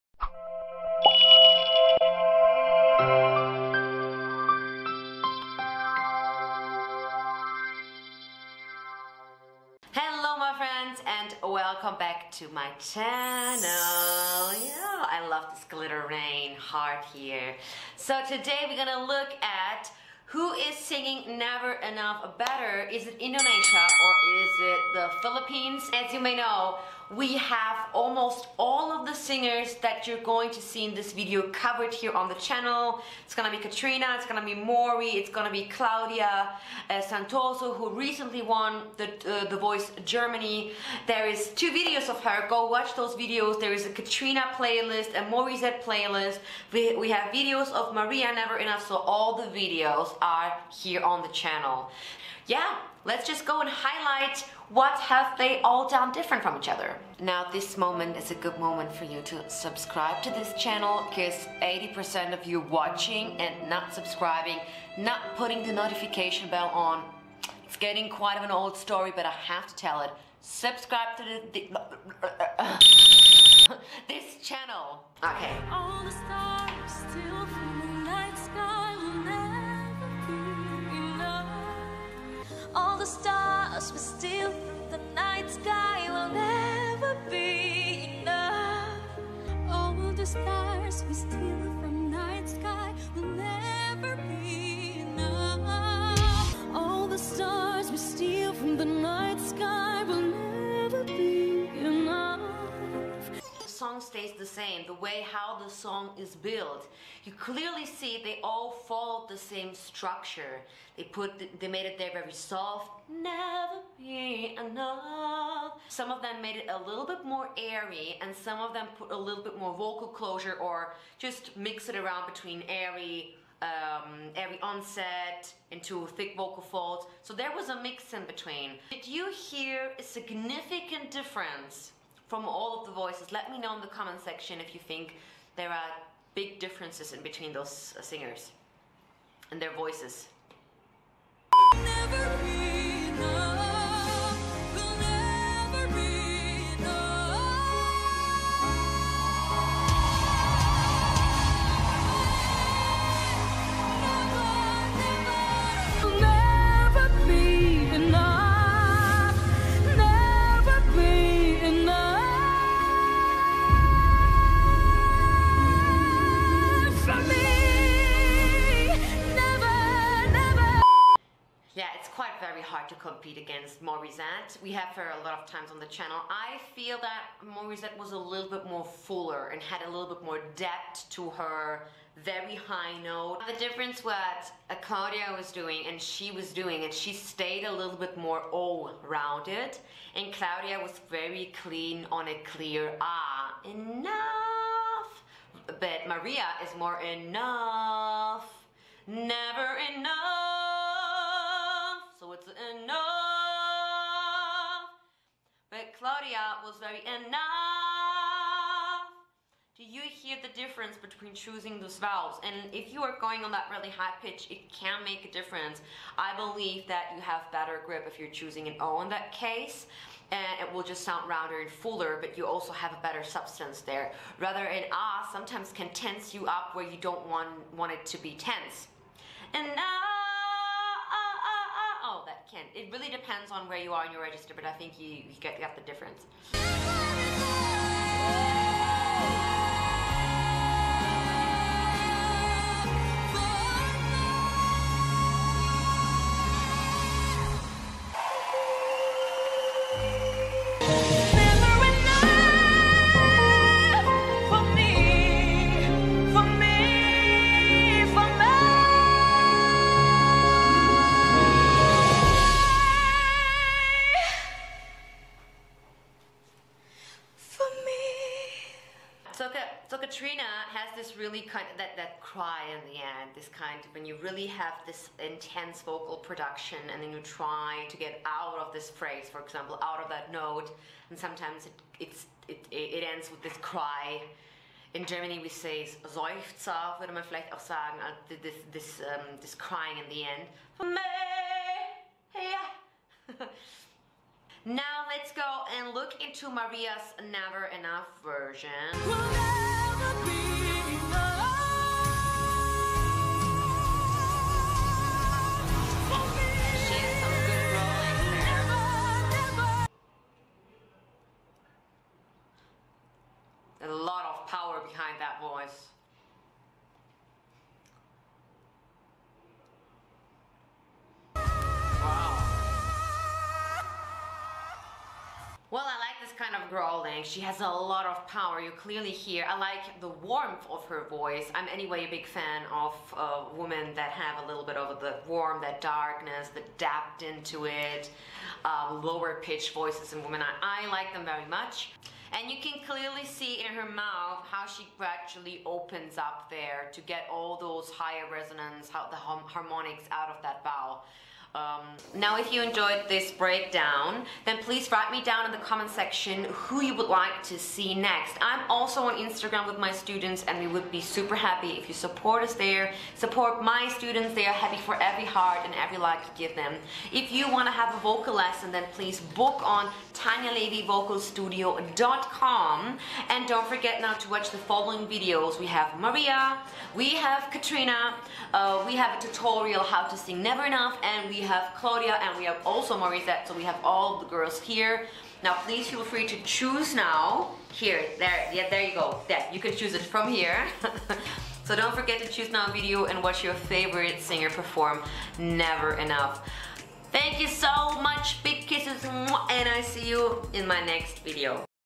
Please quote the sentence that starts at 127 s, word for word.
So there was a mix in between.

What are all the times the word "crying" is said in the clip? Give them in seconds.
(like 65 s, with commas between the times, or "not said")
289 s.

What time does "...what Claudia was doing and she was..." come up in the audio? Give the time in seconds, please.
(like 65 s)
184 s.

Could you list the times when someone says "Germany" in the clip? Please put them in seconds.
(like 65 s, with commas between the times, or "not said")
40 s, 285 s.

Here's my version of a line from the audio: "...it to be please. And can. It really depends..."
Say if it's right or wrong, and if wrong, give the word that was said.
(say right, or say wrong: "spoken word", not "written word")
wrong: "tense", not "please".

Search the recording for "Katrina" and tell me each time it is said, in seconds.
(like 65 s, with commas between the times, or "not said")
33 s, 43 s, 270 s, 377 s.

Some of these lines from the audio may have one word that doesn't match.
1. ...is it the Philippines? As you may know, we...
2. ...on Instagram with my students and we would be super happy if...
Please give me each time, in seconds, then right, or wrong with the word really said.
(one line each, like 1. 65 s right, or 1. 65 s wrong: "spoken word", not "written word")
1. 24 s right
2. 359 s right.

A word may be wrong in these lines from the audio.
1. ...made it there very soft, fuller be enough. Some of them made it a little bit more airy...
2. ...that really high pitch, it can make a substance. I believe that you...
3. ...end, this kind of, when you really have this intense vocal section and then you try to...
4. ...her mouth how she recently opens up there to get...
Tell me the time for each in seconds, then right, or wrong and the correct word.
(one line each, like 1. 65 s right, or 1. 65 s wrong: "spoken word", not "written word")
1. 111 s wrong: "never", not "fuller"
2. 213 s wrong: "difference", not "substance"
3. 272 s wrong: "production", not "section"
4. 343 s wrong: "gradually", not "recently".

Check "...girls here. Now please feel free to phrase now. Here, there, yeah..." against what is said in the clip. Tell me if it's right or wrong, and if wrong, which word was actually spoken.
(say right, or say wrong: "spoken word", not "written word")
wrong: "choose", not "phrase".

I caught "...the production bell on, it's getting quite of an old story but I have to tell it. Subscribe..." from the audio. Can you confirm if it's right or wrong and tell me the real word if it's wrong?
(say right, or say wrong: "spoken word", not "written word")
wrong: "notification", not "production".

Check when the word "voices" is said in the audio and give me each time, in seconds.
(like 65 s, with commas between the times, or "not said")
39 s, 132 s, 139 s, 331 s, 339 s.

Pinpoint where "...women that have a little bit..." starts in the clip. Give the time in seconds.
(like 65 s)
333 s.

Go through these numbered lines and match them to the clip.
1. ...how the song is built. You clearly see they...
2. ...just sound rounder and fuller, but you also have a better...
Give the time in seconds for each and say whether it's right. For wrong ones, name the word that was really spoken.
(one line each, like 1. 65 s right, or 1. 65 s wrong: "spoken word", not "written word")
1. 105 s right
2. 220 s right.